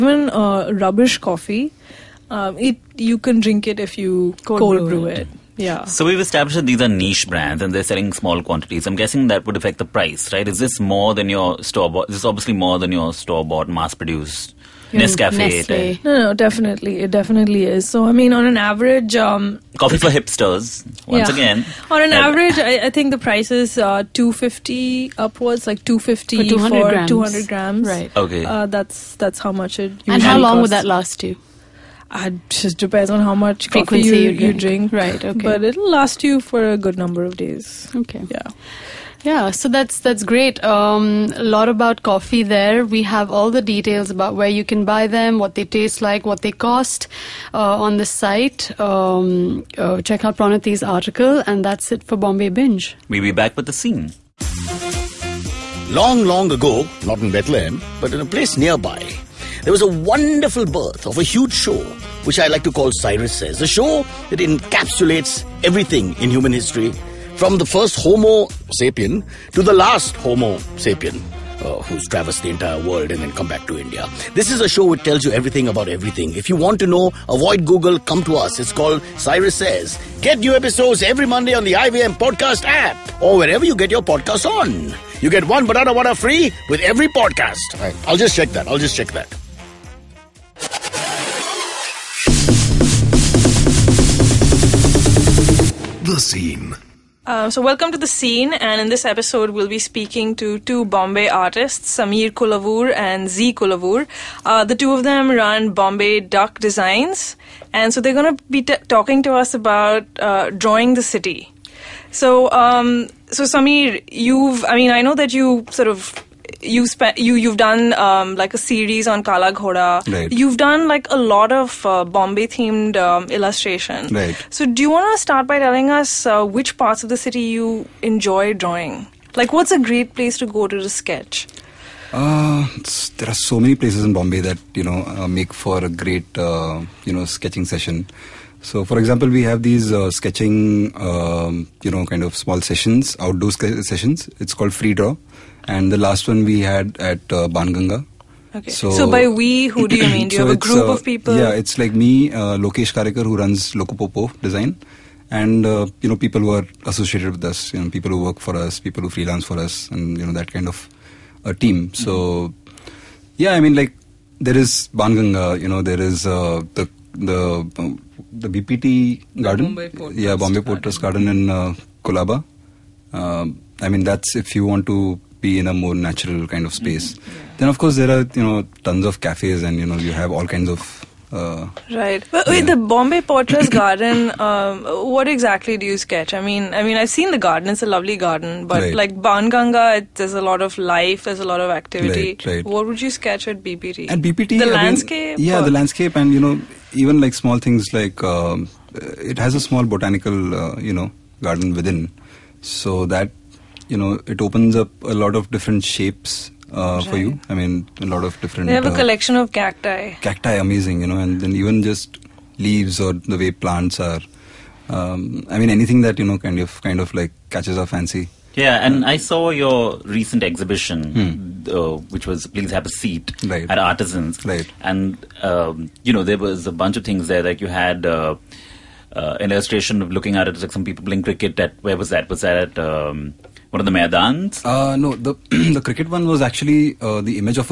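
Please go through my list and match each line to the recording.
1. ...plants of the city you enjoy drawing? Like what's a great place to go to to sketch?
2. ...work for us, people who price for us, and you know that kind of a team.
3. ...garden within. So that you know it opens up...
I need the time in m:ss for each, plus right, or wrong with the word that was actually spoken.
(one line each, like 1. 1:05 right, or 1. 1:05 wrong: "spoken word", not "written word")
1. 2:06 wrong: "parts", not "plants"
2. 2:38 wrong: "freelance", not "price"
3. 3:21 right.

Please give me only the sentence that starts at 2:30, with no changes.
Do you so have a group uh, of people?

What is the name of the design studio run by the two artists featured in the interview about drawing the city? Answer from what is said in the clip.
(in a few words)
Bombay Duck Designs.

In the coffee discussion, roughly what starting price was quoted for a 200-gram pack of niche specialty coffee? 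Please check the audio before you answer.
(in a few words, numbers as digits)
250.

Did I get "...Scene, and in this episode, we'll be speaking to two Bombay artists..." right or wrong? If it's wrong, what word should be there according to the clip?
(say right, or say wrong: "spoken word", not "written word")
right.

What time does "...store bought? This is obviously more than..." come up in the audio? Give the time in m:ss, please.
0:11.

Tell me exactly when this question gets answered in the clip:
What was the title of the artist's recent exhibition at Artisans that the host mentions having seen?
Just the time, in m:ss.
3:42.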